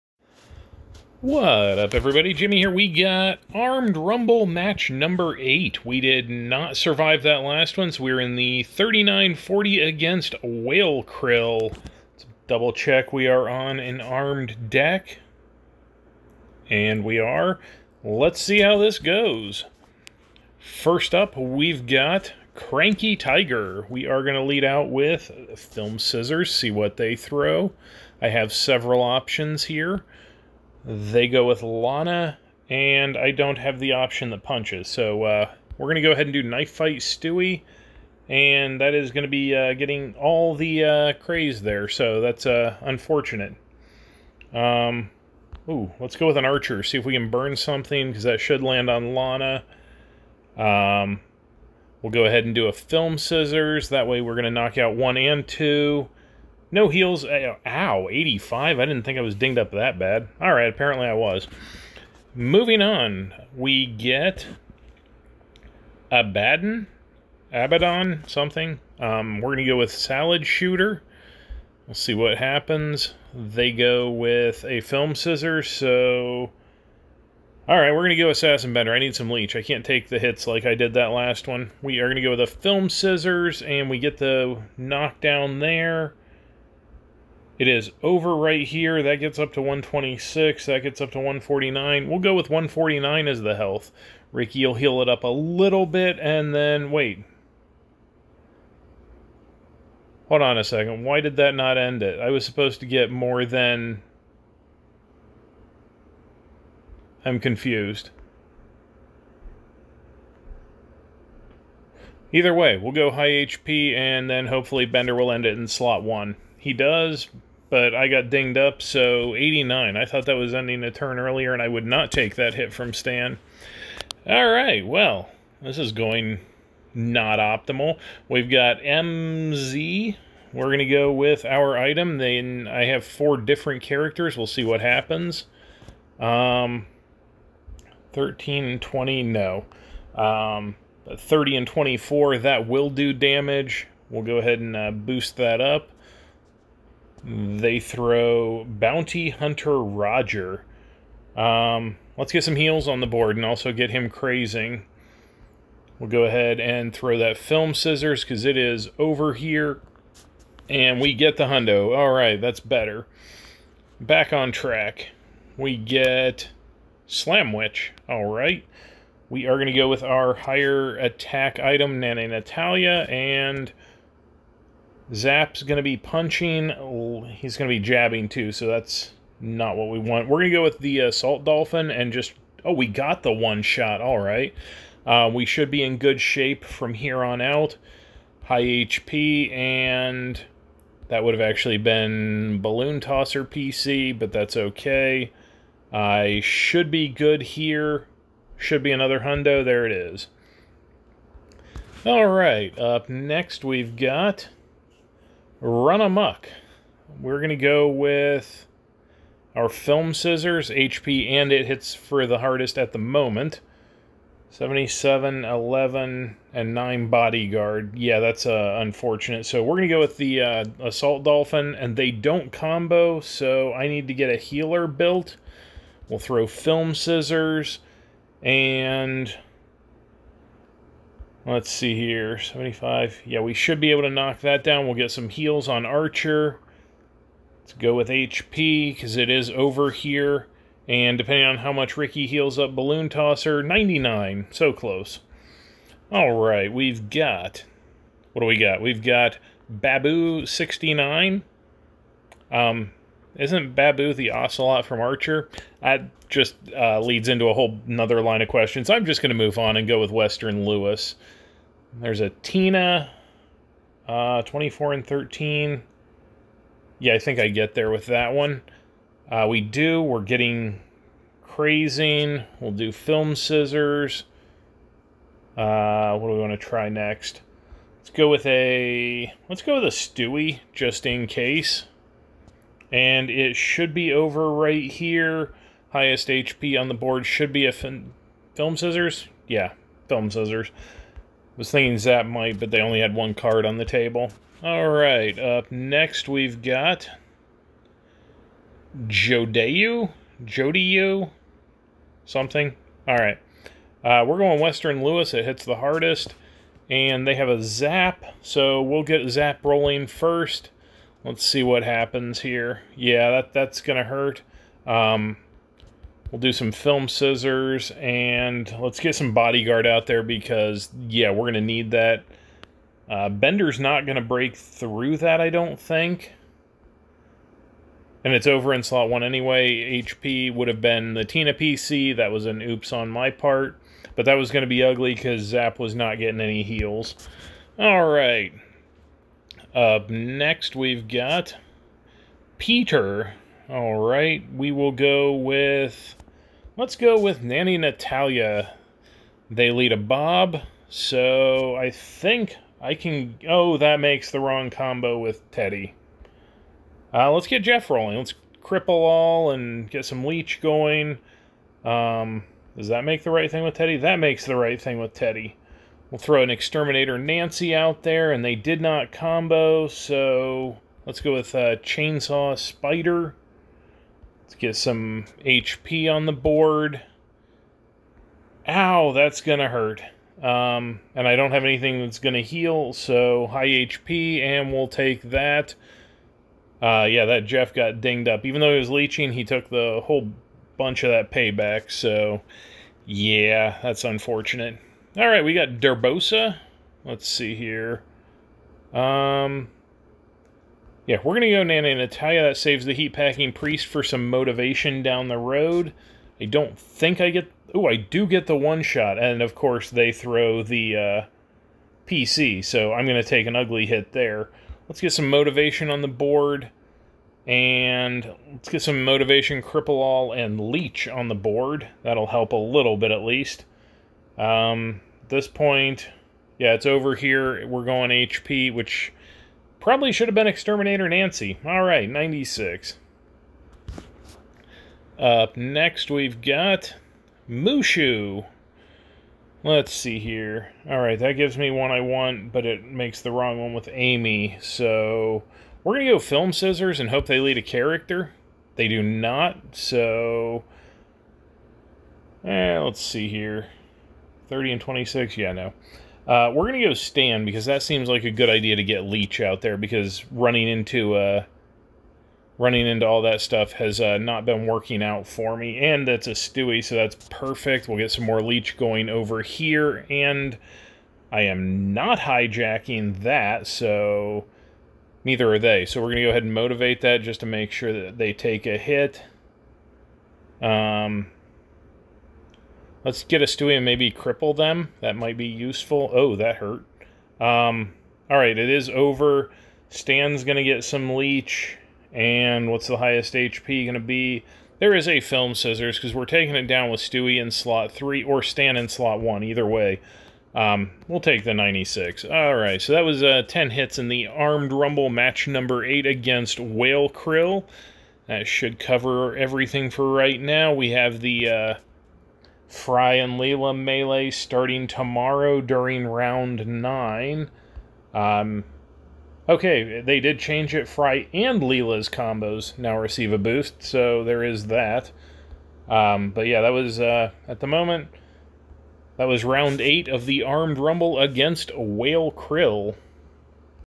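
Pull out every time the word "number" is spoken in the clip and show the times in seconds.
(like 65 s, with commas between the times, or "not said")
4 s, 505 s.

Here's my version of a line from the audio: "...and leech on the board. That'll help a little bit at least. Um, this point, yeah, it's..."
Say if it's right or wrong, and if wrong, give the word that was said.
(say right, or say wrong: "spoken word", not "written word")
right.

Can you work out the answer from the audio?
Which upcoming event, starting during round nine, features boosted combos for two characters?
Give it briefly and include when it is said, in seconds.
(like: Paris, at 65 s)
Fry and Leela melee, at 512 s.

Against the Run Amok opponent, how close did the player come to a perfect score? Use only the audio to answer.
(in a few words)
99.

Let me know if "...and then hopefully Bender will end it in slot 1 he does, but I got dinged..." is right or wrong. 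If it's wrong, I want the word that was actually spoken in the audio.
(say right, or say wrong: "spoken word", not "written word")
right.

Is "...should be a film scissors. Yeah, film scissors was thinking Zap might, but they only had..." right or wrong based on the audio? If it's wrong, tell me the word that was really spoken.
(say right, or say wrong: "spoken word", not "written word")
right.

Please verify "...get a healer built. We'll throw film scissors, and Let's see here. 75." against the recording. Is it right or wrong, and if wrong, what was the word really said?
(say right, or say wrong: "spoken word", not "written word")
right.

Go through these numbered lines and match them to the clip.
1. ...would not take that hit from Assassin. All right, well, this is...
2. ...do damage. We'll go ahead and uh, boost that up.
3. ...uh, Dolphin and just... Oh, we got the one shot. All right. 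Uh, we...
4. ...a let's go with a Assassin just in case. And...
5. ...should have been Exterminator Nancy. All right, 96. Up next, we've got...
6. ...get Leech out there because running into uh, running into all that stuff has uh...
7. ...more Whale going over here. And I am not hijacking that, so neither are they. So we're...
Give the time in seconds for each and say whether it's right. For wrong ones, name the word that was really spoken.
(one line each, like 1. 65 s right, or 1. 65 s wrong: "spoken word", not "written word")
1. 121 s wrong: "Stan", not "Assassin"
2. 142 s right
3. 181 s right
4. 278 s wrong: "Stewie", not "Assassin"
5. 430 s right
6. 458 s right
7. 468 s wrong: "Leech", not "Whale".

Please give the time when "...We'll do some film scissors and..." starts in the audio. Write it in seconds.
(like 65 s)
316 s.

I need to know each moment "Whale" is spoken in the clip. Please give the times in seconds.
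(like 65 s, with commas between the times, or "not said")
10 s, 506 s, 531 s.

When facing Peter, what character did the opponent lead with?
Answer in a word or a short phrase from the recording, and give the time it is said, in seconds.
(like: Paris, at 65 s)
Bob, at 349 s.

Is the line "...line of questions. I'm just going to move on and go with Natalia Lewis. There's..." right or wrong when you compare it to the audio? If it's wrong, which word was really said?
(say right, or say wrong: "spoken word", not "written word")
wrong: "Western", not "Natalia".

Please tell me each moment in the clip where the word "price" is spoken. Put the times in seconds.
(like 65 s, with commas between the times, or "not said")
not said.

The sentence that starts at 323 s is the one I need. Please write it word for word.
Uh, Bender's not going to break through that, I don't think.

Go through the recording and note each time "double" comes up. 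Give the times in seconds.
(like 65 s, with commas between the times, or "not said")
12 s.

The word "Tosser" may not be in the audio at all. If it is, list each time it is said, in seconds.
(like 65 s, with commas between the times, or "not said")
192 s, 243 s.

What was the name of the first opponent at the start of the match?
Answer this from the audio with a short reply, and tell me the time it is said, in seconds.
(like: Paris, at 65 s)
Cranky Tiger, at 22 s.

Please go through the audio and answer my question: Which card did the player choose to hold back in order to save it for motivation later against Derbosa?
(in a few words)
Heat Packing Priest.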